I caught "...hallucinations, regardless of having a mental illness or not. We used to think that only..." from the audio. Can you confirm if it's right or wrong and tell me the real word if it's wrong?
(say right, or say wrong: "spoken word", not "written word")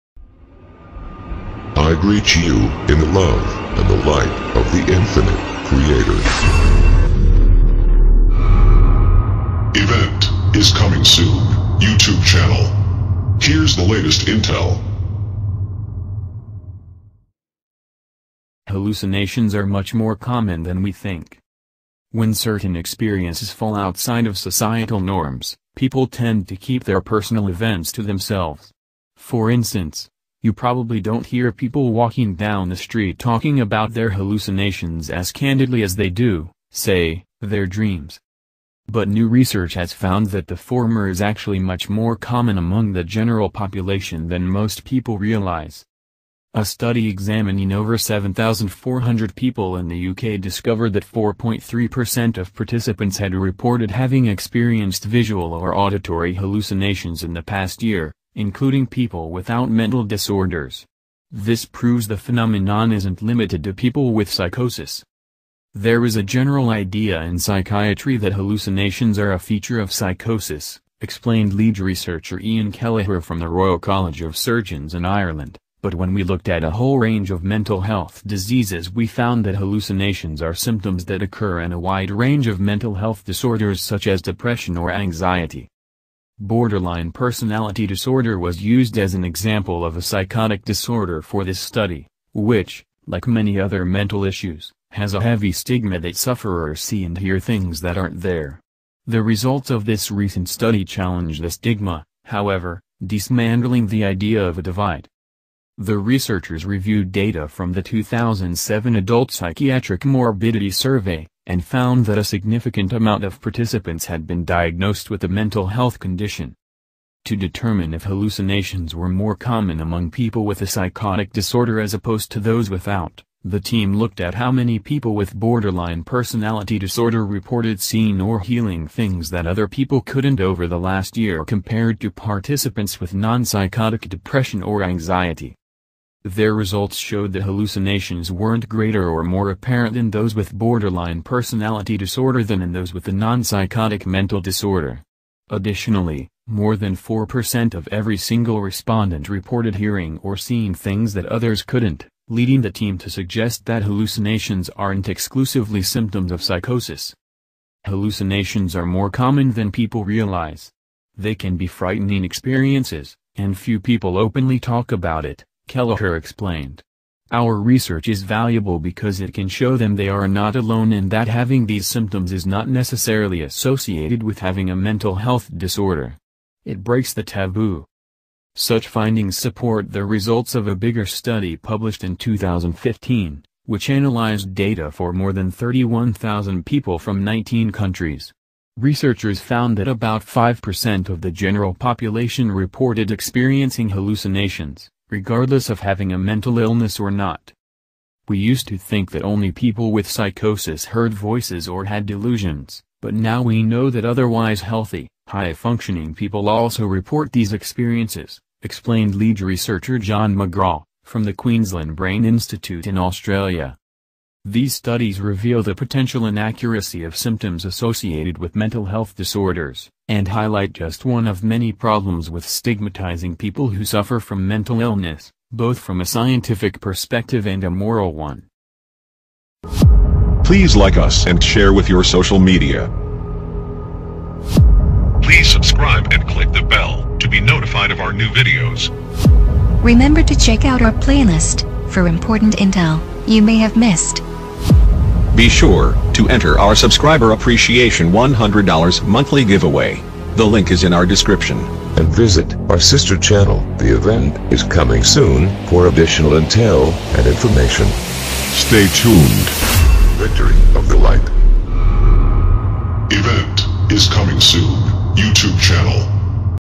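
right.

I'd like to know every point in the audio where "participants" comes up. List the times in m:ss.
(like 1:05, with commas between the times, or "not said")
0:52, 1:53, 2:12.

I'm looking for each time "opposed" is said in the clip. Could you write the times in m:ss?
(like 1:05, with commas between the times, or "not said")
2:01.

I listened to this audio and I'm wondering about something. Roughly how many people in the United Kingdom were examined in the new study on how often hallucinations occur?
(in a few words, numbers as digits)
7,400.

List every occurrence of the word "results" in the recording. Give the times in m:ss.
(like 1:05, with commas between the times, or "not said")
1:39, 2:16, 3:00.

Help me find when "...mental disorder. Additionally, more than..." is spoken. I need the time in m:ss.
2:24.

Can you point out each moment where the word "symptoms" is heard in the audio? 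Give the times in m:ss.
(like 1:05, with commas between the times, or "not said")
1:20, 2:35, 2:51, 3:37.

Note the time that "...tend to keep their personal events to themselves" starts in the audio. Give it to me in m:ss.
0:26.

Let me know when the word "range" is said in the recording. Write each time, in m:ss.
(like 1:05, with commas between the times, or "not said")
1:16, 1:22.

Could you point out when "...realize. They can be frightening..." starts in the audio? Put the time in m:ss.
2:40.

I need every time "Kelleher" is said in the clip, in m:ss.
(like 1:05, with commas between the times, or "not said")
1:12, 2:45.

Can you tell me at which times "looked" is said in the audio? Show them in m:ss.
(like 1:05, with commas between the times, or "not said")
1:16, 2:03.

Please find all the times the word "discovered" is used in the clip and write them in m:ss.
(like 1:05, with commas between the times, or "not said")
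0:50.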